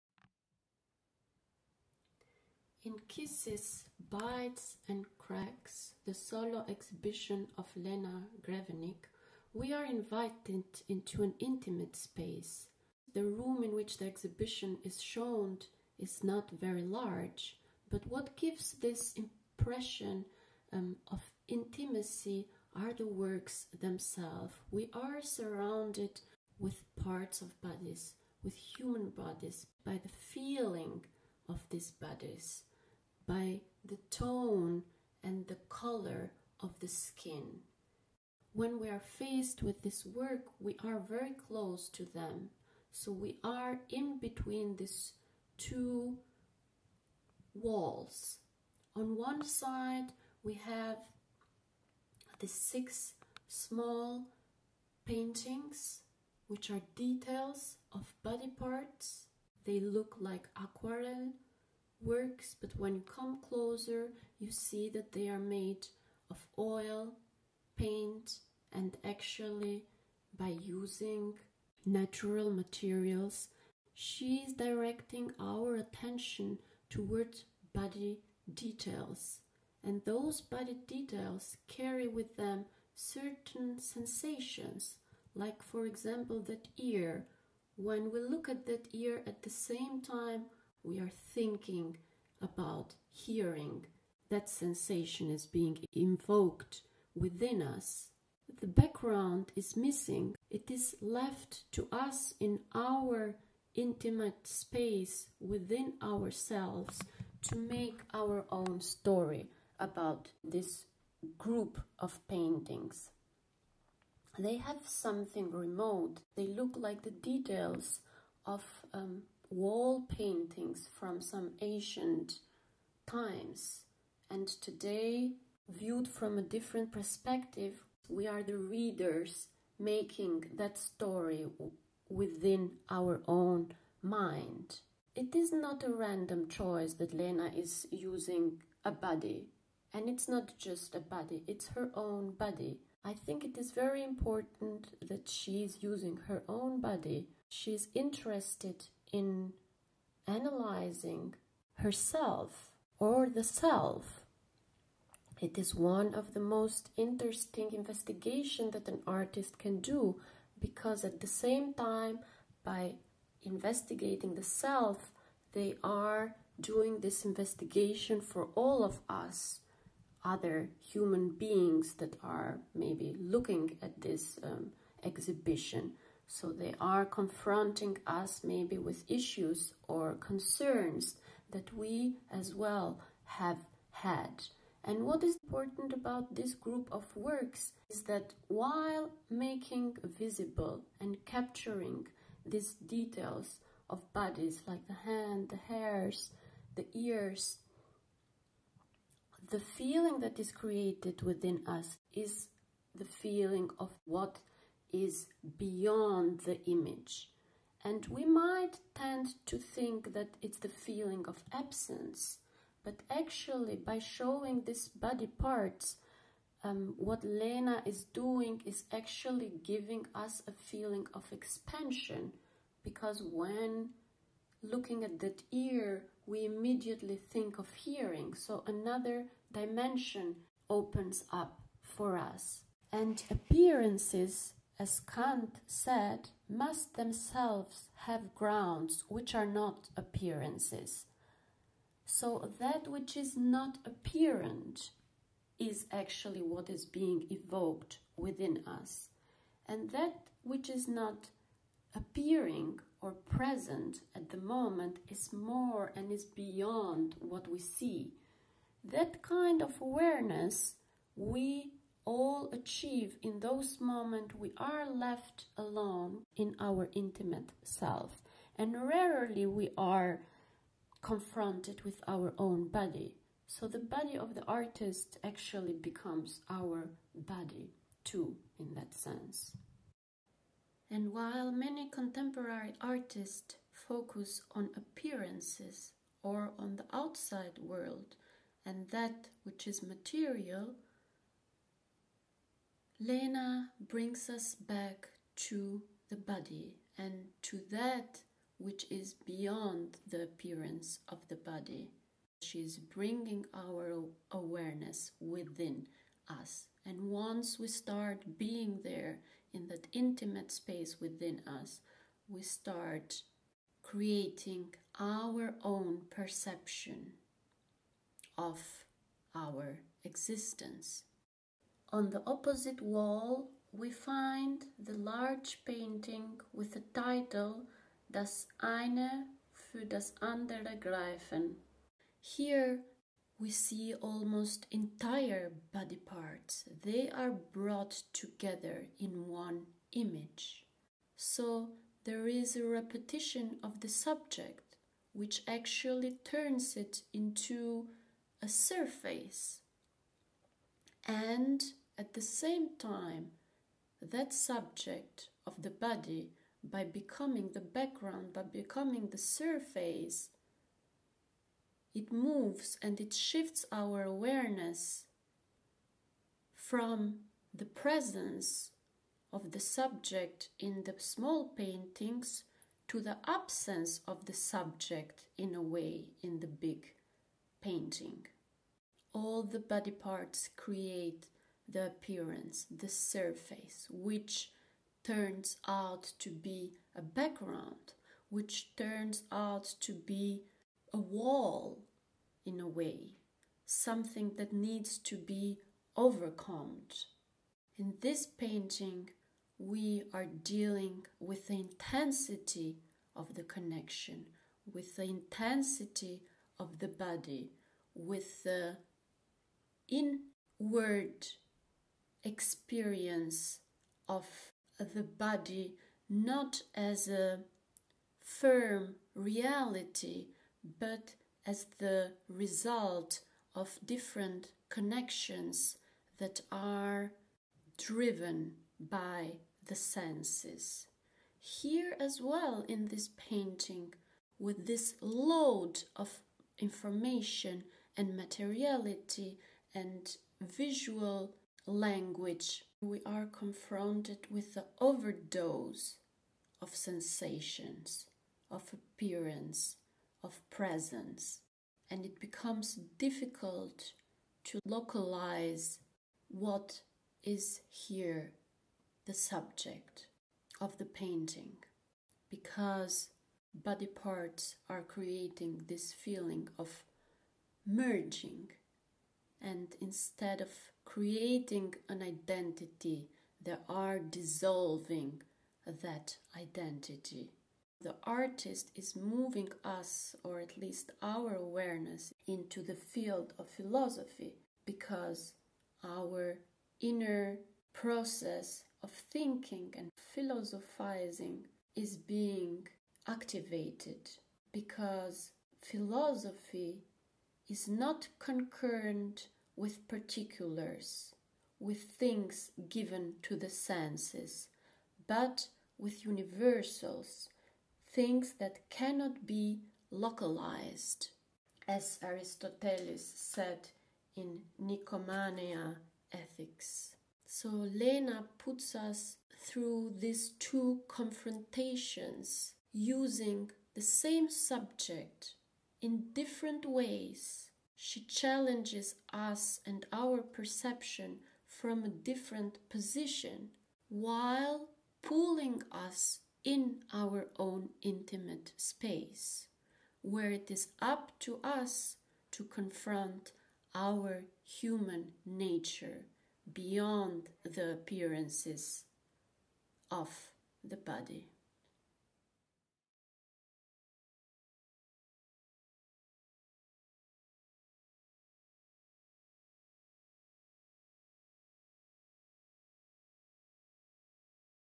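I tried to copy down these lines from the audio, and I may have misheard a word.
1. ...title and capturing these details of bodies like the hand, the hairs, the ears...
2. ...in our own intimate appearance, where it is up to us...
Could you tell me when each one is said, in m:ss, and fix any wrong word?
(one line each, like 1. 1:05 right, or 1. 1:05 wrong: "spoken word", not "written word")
1. 3:10 wrong: "visible", not "title"
2. 8:56 wrong: "space", not "appearance".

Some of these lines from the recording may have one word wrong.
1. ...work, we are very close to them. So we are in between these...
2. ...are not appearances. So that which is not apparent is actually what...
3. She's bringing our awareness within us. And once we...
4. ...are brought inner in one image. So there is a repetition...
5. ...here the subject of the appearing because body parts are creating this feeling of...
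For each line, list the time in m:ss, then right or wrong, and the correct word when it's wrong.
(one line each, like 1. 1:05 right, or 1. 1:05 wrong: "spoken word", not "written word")
1. 0:40 right
2. 3:59 right
3. 5:02 right
4. 5:37 wrong: "together", not "inner"
5. 7:37 wrong: "painting", not "appearing".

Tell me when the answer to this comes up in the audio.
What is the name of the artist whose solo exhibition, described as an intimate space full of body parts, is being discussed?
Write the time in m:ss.
0:07.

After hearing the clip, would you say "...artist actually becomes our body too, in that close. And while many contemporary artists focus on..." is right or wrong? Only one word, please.
wrong.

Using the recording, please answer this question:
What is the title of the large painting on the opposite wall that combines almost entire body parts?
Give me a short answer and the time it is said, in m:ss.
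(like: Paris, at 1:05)
Das eine für das andere greifen, at 5:28.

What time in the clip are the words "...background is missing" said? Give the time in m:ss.
1:38.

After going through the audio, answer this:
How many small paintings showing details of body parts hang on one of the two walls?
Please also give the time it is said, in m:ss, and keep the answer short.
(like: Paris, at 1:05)
6, at 0:52.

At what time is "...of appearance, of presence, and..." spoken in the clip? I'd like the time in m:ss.
7:28.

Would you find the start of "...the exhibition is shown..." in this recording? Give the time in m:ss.
0:13.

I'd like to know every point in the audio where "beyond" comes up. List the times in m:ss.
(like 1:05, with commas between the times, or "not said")
3:25, 4:16, 4:59, 9:06.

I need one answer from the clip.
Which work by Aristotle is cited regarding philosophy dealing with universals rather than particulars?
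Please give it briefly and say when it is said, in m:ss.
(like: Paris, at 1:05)
Nicomachean Ethics, at 8:34.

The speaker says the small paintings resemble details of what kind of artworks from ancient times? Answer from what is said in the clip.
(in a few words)
Wall paintings.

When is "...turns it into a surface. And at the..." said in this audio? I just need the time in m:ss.
5:46.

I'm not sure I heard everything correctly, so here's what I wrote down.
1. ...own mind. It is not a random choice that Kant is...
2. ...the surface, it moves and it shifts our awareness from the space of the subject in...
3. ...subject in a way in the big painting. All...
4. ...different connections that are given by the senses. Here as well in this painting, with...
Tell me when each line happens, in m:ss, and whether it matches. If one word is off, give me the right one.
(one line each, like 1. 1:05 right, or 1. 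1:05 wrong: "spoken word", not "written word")
1. 2:13 wrong: "Lena", not "Kant"
2. 5:59 wrong: "presence", not "space"
3. 6:14 right
4. 7:03 wrong: "driven", not "given".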